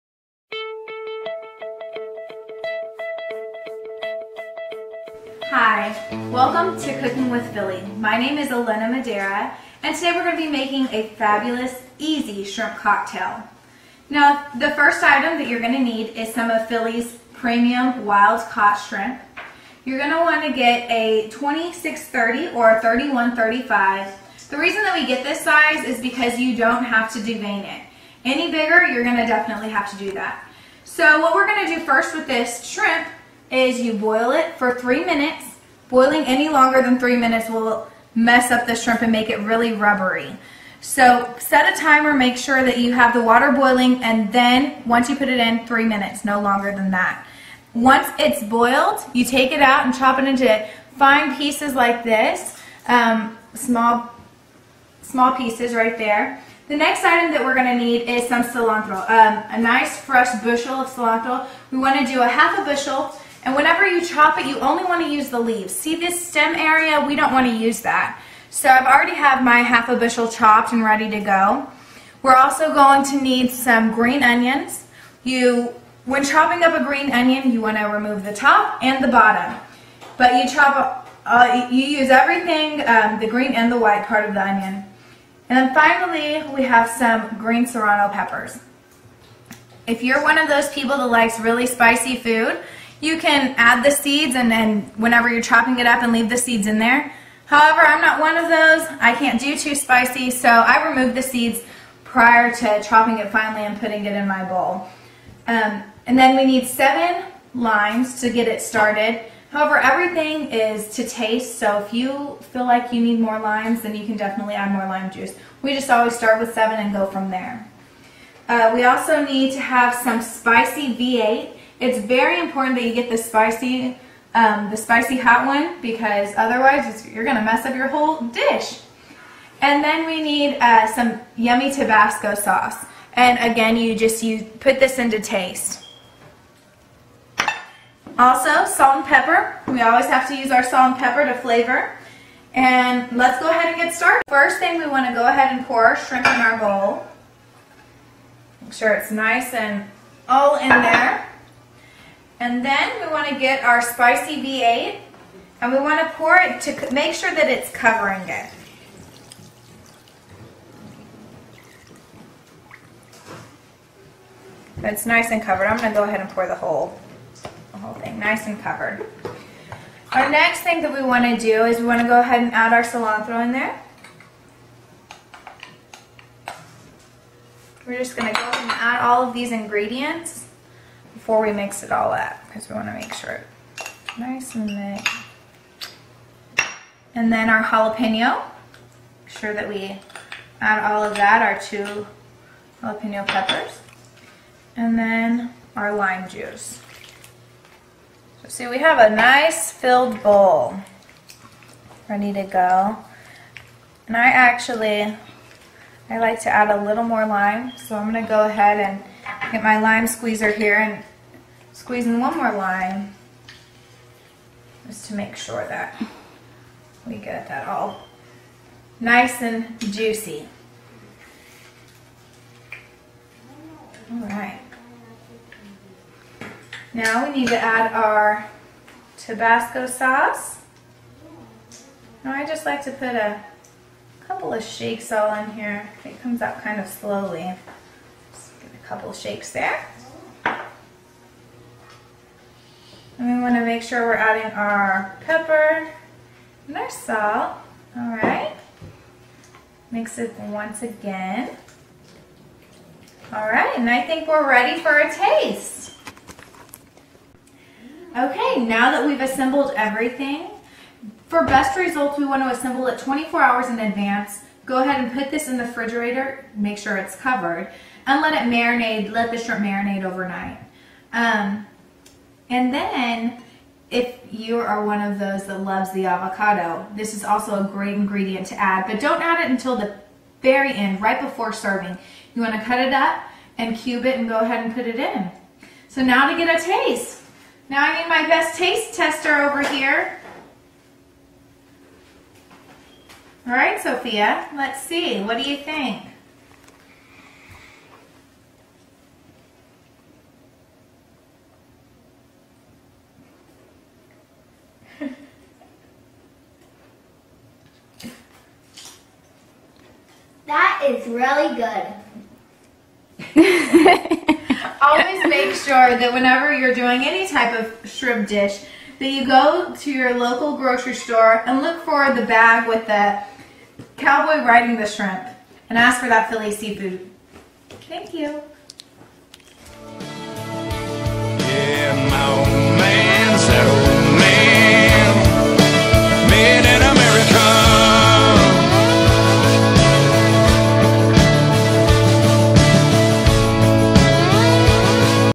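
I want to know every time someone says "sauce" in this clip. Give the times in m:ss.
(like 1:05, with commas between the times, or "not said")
2:12, 3:49.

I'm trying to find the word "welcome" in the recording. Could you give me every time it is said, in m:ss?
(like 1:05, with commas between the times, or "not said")
0:06.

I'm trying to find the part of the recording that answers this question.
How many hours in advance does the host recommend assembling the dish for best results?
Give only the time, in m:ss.
4:22.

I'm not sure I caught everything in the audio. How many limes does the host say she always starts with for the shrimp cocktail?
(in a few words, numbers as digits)
7.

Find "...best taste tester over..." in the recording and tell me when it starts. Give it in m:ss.
4:48.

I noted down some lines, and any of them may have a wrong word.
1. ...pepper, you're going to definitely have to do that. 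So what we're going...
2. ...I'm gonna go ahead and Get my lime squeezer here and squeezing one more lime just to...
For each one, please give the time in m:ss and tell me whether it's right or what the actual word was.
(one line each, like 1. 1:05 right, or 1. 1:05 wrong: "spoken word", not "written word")
1. 0:28 wrong: "bigger", not "pepper"
2. 3:27 right.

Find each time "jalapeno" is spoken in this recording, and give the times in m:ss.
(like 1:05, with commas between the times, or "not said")
3:07, 3:12.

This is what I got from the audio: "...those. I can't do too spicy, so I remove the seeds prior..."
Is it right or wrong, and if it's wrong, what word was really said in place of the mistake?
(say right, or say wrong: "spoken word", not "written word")
right.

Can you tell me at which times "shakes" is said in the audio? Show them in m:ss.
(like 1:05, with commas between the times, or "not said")
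3:54, 3:59.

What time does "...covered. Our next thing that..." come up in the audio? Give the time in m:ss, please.
2:48.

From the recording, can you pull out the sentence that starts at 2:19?
We always have to use our salt and pepper to flavor.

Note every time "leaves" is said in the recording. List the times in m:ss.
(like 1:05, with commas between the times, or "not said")
1:05, 1:36.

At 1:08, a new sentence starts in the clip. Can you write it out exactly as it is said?
So I've already have my half a bushel chopped and ready to go.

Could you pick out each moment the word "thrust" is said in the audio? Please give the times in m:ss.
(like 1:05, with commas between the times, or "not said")
not said.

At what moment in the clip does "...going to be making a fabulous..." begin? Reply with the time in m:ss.
0:10.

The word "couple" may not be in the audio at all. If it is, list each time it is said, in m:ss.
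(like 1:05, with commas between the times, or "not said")
3:54, 3:58.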